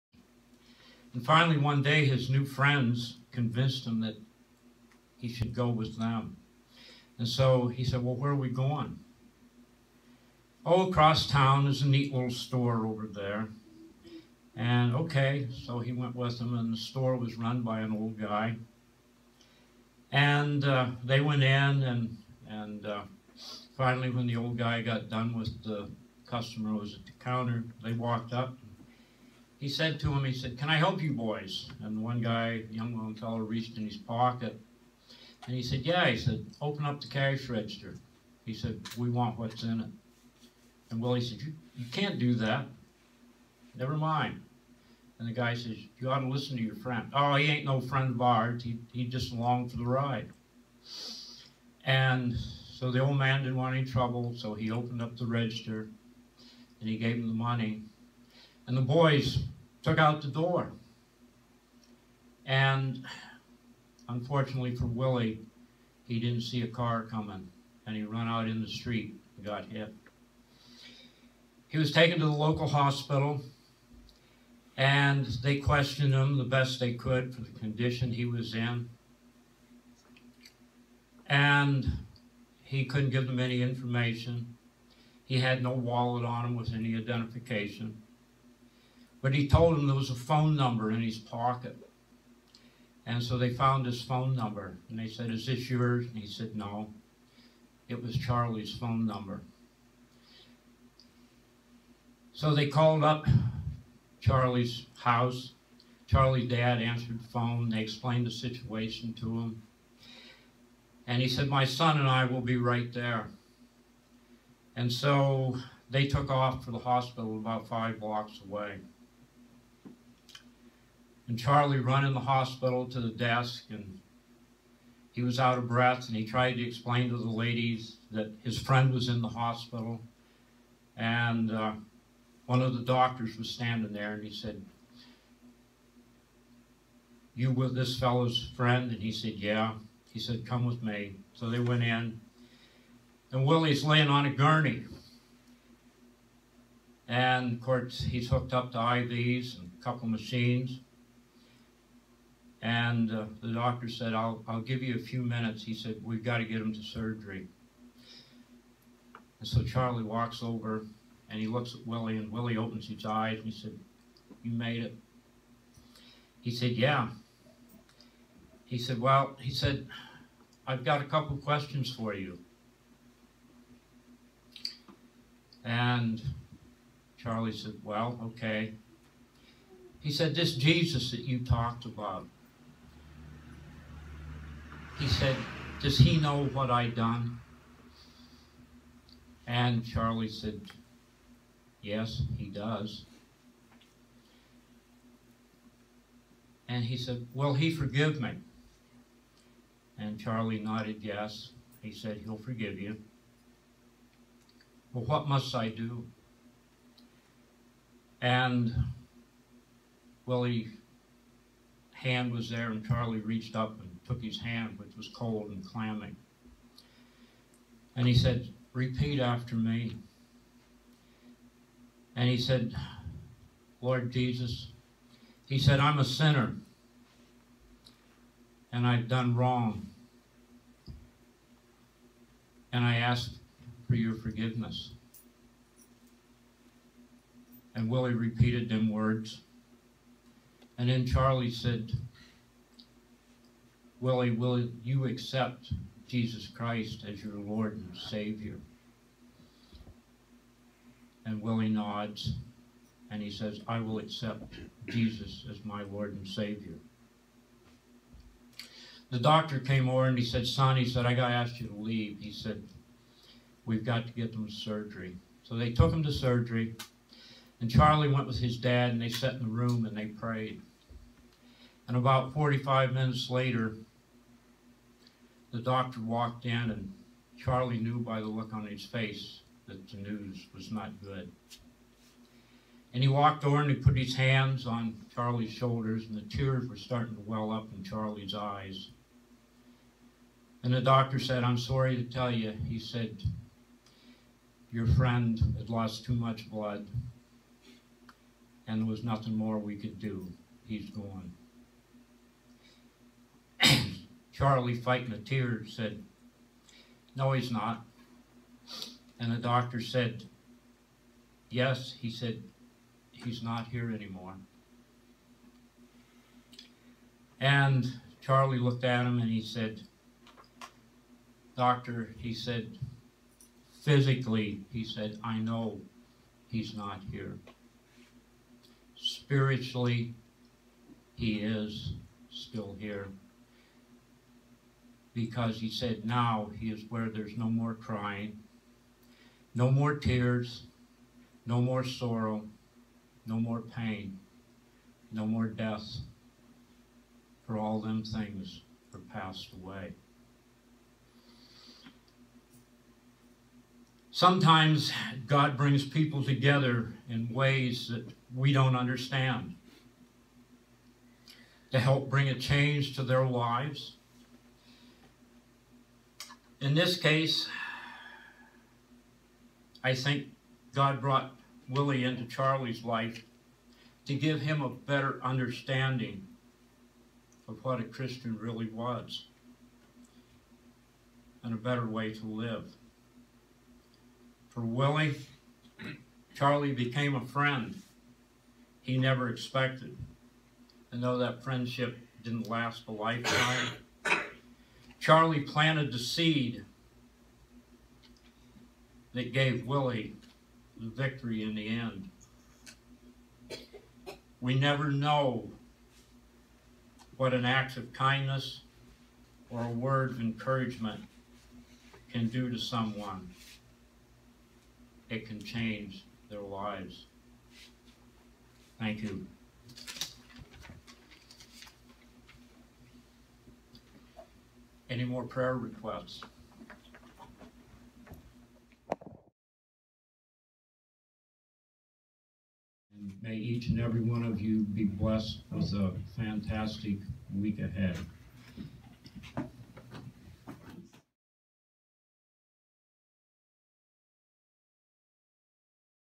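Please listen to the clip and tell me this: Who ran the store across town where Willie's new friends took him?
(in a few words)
An old guy.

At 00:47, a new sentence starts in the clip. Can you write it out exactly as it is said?
Oh, he ain't no friend of ours.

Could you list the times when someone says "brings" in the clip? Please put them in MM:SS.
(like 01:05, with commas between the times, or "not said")
05:55, 06:02.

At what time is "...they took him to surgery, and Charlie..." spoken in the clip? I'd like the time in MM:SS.
04:25.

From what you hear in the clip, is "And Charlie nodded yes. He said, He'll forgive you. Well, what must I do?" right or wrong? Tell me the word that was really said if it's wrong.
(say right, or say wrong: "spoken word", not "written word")
right.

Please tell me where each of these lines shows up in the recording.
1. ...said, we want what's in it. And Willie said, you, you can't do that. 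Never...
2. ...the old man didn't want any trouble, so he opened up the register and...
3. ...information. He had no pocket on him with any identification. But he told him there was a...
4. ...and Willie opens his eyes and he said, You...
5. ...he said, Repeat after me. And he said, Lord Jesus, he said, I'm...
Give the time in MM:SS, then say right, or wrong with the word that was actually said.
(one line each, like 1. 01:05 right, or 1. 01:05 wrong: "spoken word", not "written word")
1. 00:38 right
2. 00:52 right
3. 01:23 wrong: "wallet", not "pocket"
4. 02:42 right
5. 03:38 right.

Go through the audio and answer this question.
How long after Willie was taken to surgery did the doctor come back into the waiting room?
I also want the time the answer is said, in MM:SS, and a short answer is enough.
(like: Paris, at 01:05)
About 45 minutes, at 04:31.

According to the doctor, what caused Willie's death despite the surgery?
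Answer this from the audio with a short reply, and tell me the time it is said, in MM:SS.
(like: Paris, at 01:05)
Lost too much blood, at 04:55.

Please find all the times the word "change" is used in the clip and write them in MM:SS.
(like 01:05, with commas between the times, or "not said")
06:02, 06:55.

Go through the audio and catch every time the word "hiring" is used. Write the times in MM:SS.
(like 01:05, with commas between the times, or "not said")
not said.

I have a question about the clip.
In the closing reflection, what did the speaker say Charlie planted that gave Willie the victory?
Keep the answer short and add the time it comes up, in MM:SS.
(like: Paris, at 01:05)
The seed, at 06:35.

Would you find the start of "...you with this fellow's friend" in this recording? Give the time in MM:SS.
02:17.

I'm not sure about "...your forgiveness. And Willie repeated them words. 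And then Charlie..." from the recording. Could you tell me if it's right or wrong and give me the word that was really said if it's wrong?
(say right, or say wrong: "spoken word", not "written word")
right.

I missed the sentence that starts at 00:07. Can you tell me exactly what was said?
And so he said, Well, where are we going?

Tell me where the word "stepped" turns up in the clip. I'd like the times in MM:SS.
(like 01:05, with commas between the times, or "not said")
not said.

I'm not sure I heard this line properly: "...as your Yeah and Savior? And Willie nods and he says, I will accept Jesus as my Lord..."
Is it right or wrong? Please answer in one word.
wrong.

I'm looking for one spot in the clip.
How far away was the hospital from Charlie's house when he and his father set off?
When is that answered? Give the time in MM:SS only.
01:57.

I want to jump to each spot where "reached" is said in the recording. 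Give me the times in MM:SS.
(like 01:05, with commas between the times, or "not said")
00:33, 03:33.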